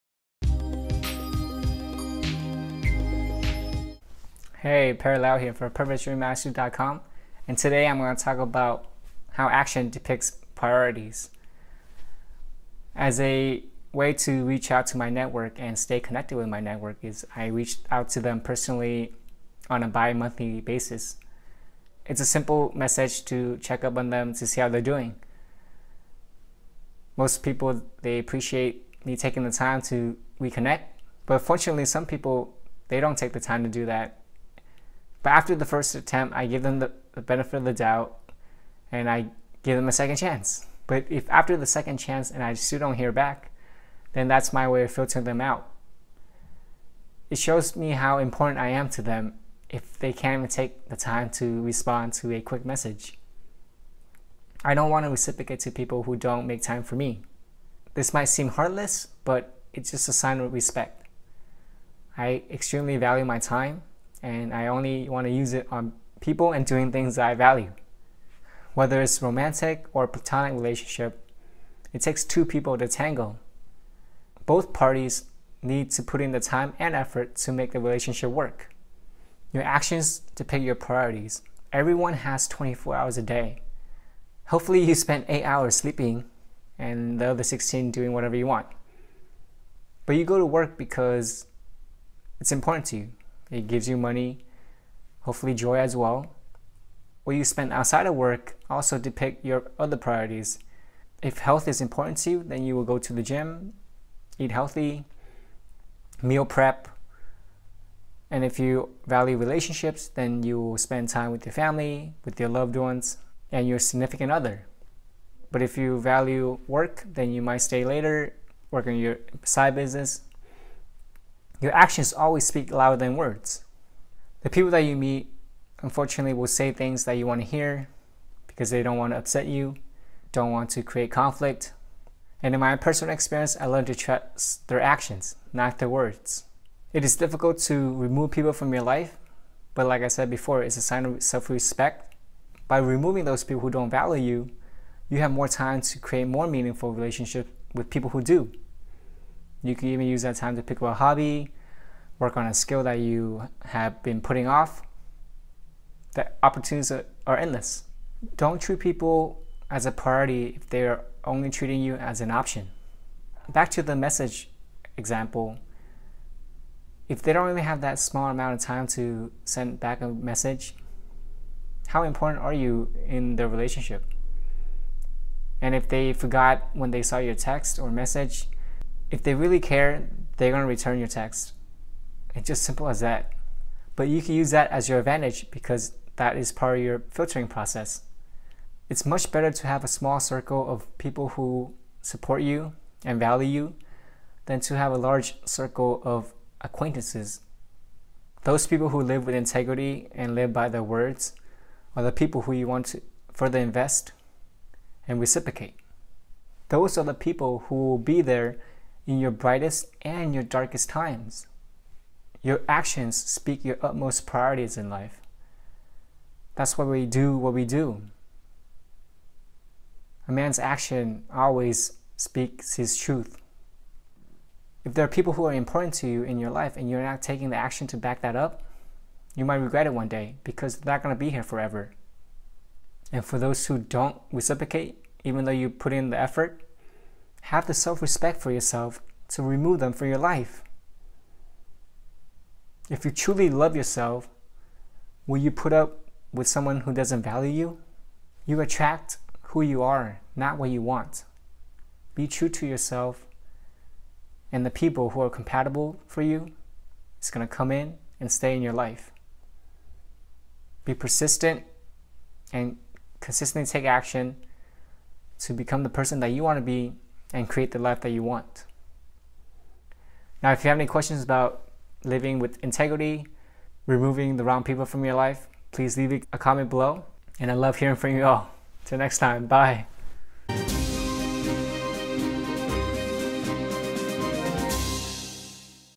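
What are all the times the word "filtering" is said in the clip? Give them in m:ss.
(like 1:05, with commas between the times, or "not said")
0:44, 3:07.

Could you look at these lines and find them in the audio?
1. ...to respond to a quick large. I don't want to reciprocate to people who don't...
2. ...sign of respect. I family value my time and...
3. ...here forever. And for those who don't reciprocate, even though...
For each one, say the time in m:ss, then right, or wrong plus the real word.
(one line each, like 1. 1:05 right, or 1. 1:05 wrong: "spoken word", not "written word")
1. 0:51 wrong: "message", not "large"
2. 1:00 wrong: "extremely", not "family"
3. 3:51 right.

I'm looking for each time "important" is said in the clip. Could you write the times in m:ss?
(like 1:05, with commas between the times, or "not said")
0:48, 1:32, 1:41, 2:52, 3:45.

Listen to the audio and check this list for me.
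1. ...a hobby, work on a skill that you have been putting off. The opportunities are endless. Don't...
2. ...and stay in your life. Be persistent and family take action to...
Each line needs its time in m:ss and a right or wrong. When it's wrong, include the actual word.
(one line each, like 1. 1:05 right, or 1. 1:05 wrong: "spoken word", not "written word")
1. 2:30 right
2. 4:18 wrong: "consistently", not "family".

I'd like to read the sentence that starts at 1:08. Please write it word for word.
Whether it's romantic or platonic relationship, it takes two people to tango.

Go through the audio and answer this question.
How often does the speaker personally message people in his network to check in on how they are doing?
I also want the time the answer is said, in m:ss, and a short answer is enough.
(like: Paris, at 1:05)
Bi-monthly, at 0:19.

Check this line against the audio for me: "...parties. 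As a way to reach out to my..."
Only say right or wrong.
wrong.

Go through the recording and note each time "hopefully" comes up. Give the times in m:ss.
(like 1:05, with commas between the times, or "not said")
1:24, 1:35.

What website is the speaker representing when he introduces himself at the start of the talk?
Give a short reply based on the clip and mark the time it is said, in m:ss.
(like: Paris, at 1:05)
PurposeDrivenMastery.com, at 0:05.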